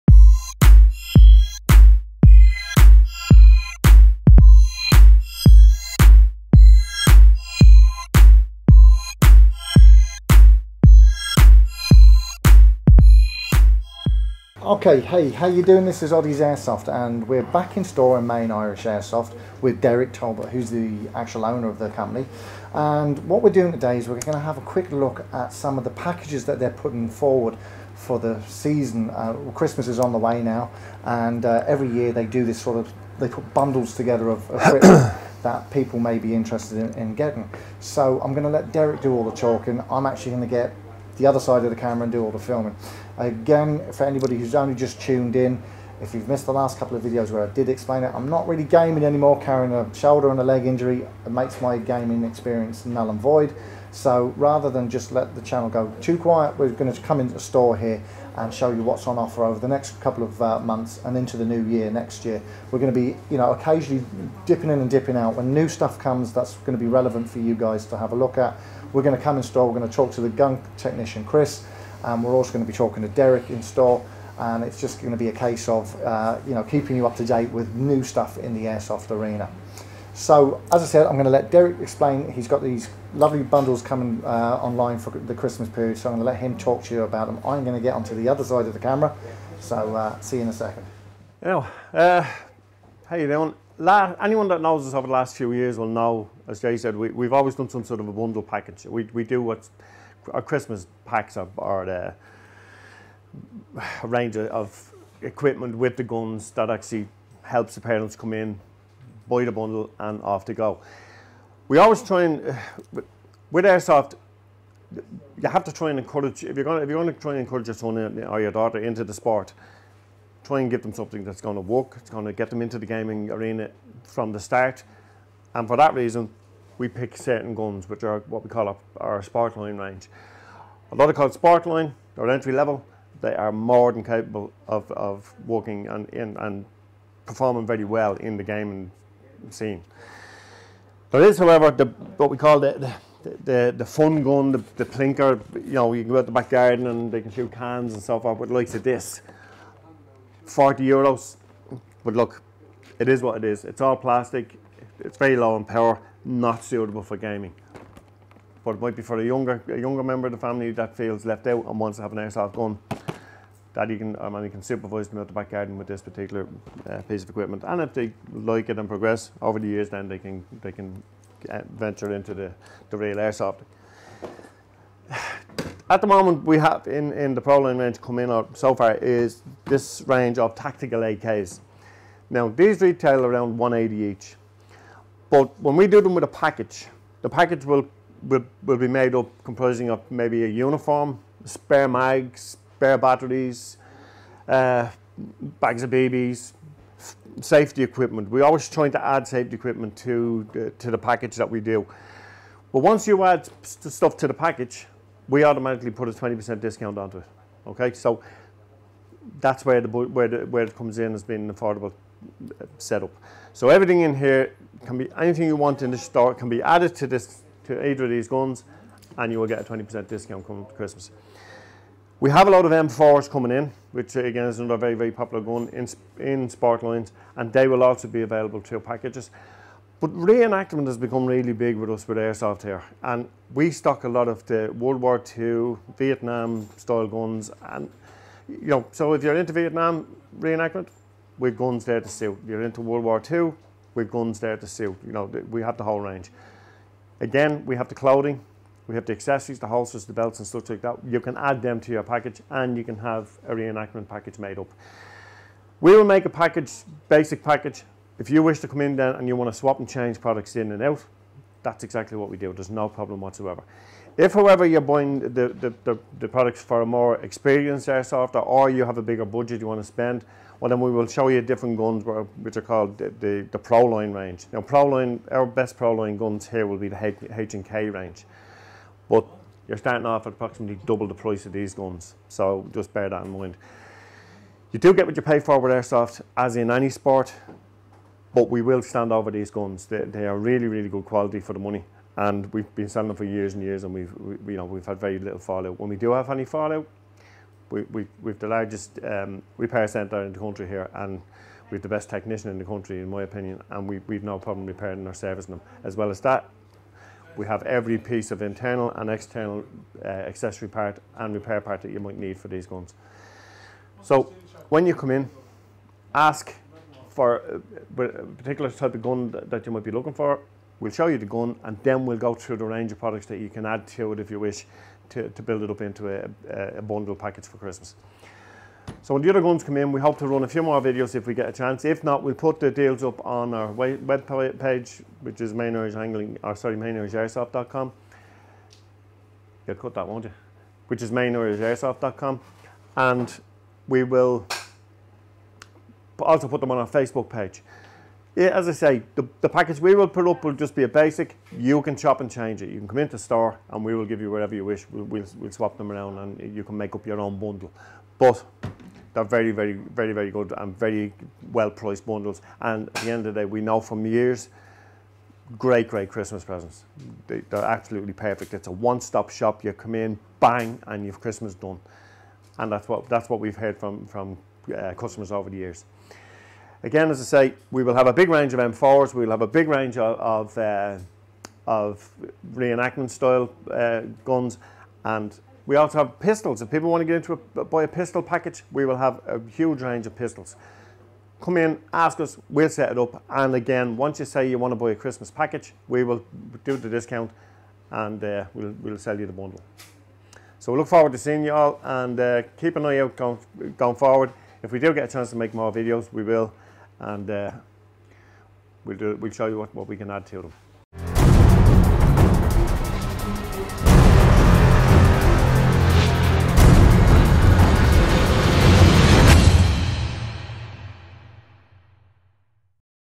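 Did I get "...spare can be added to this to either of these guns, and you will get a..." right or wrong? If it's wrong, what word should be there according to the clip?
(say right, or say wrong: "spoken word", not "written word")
wrong: "store", not "spare".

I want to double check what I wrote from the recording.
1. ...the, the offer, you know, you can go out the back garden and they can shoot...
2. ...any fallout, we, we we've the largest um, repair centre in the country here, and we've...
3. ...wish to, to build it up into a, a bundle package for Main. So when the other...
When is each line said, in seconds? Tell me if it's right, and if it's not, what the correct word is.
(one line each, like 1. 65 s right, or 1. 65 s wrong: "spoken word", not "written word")
1. 144 s wrong: "plinker", not "offer"
2. 296 s right
3. 324 s wrong: "Christmas", not "Main".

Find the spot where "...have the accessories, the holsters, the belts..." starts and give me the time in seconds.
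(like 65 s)
248 s.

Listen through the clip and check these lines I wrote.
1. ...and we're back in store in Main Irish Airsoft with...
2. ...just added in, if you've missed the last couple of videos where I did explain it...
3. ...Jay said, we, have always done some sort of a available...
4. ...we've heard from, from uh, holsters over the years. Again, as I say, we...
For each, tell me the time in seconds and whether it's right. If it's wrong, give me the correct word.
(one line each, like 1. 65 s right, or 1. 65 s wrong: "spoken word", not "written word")
1. 16 s right
2. 44 s wrong: "tuned", not "added"
3. 96 s wrong: "bundle", not "available"
4. 373 s wrong: "customers", not "holsters".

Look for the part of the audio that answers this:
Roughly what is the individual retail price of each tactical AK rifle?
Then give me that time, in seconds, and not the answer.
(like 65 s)
183 s.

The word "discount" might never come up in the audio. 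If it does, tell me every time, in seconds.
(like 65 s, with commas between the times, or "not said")
206 s, 220 s, 396 s.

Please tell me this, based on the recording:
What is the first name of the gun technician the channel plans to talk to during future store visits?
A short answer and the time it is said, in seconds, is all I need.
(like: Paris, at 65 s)
Chris, at 71 s.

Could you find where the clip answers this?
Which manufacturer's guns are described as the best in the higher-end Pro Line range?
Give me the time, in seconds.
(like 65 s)
277 s.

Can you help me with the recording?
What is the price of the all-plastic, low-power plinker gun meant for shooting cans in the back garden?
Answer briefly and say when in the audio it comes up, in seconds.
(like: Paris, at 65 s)
40 euros, at 150 s.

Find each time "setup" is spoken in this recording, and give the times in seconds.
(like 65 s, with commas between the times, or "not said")
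212 s.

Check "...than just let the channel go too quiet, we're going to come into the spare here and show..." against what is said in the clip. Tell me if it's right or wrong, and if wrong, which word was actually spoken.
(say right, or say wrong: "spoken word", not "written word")
wrong: "store", not "spare".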